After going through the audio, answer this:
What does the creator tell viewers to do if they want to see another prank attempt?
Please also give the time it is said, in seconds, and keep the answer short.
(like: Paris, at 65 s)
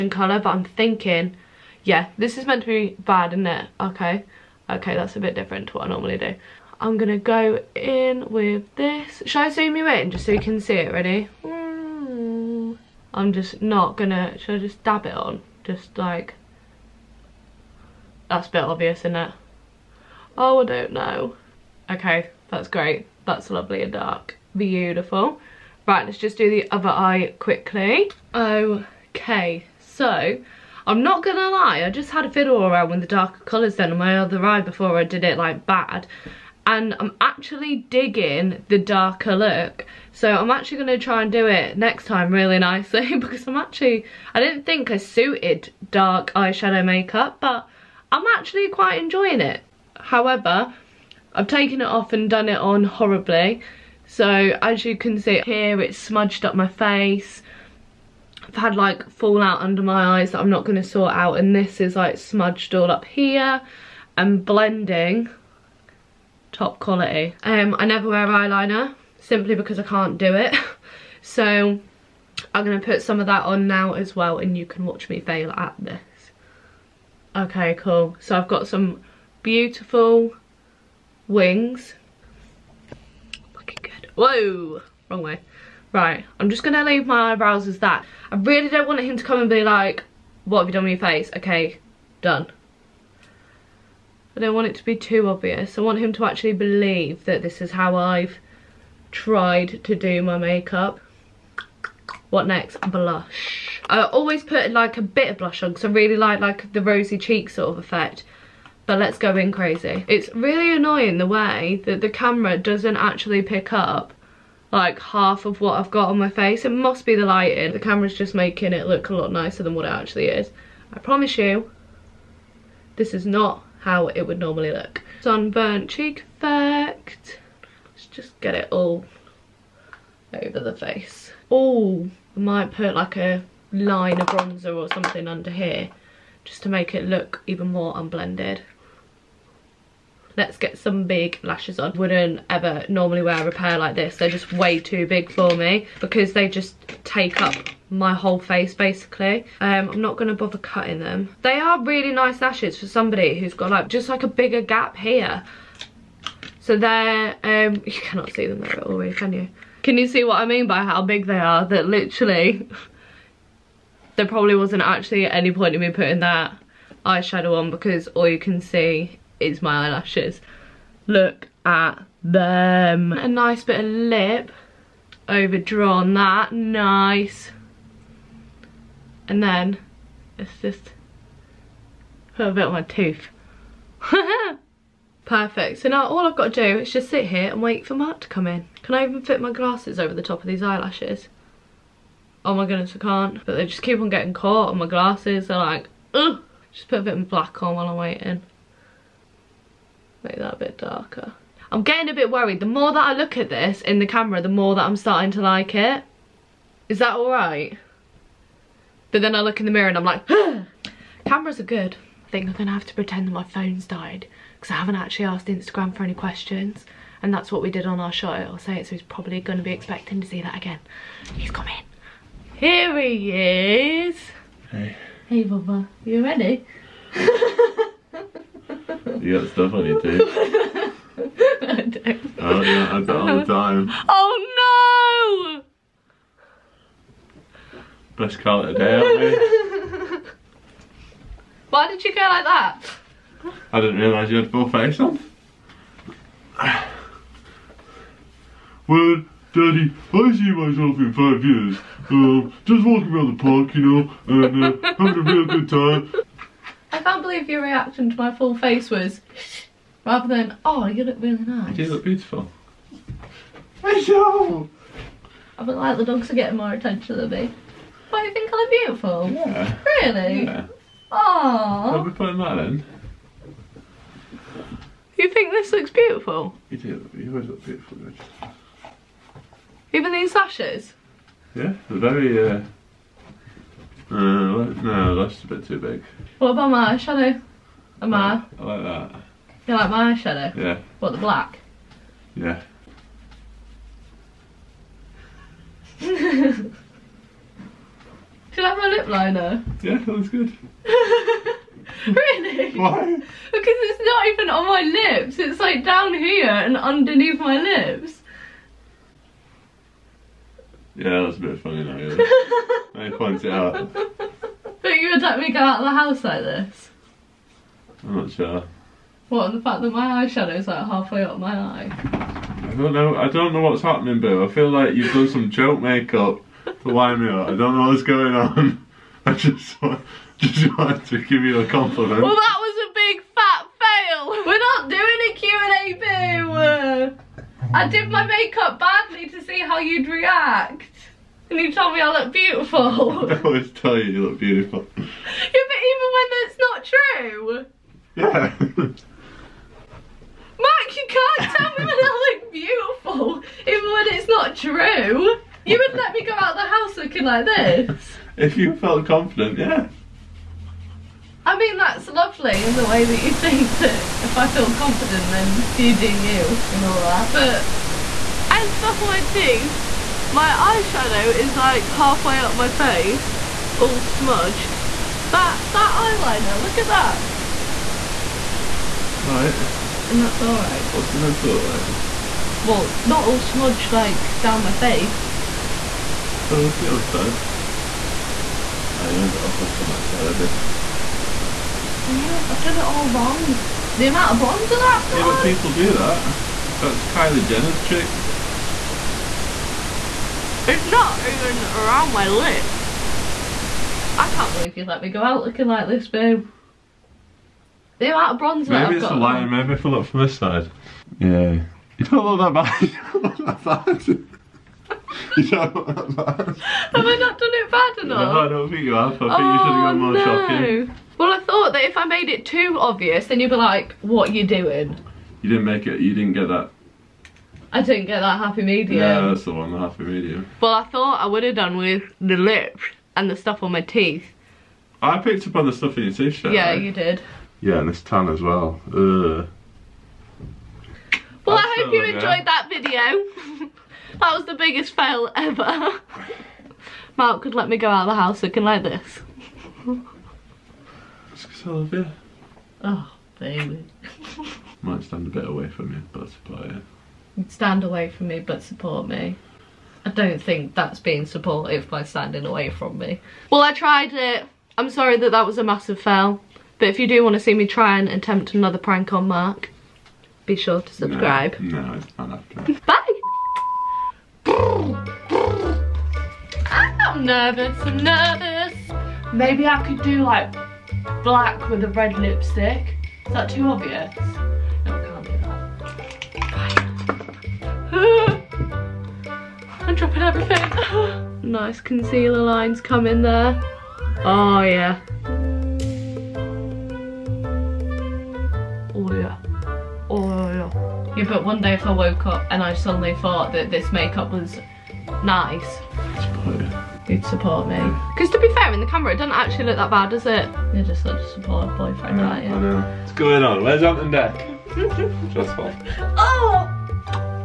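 Subscribe, at 470 s.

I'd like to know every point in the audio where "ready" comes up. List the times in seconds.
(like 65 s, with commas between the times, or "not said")
10 s, 226 s.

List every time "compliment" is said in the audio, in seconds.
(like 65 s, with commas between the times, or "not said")
331 s.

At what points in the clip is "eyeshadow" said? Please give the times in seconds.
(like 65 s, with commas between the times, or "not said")
46 s, 167 s, 320 s, 370 s.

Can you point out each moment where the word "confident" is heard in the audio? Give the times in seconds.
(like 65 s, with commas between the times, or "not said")
359 s, 364 s.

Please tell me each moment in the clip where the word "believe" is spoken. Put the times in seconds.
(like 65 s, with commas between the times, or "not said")
96 s, 257 s, 404 s.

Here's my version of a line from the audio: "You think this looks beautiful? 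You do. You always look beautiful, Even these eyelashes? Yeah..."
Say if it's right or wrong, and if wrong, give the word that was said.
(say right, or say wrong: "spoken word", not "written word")
wrong: "lashes", not "eyelashes".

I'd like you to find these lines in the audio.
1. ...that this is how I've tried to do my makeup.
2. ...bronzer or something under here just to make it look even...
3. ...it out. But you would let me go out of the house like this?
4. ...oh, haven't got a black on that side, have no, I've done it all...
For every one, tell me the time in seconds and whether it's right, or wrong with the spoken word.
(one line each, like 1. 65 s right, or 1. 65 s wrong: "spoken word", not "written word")
1. 97 s right
2. 134 s right
3. 313 s right
4. 388 s wrong: "flick", not "black".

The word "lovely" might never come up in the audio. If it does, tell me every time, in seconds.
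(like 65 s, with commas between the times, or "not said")
23 s, 362 s.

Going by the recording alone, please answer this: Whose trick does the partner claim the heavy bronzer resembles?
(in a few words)
Kylie Jenner.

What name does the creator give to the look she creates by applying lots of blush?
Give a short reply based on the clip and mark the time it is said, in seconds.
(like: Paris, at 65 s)
Sunburnt cheek effect, at 125 s.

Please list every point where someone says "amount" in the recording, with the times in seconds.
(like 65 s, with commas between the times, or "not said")
394 s, 408 s.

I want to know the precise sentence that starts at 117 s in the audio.
The camera's just making it look a lot nicer than what it actually is.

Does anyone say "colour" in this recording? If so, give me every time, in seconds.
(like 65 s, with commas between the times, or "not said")
0 s, 33 s.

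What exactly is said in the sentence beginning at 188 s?
Can I even fit my glasses over the top of these eyelashes?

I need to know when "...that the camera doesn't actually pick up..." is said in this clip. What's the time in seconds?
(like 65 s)
111 s.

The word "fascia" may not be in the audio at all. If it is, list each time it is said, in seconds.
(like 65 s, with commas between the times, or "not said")
not said.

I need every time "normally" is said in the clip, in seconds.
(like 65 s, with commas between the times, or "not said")
5 s, 124 s, 142 s.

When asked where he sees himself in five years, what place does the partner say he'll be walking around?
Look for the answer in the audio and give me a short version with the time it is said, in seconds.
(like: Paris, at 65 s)
The park, at 253 s.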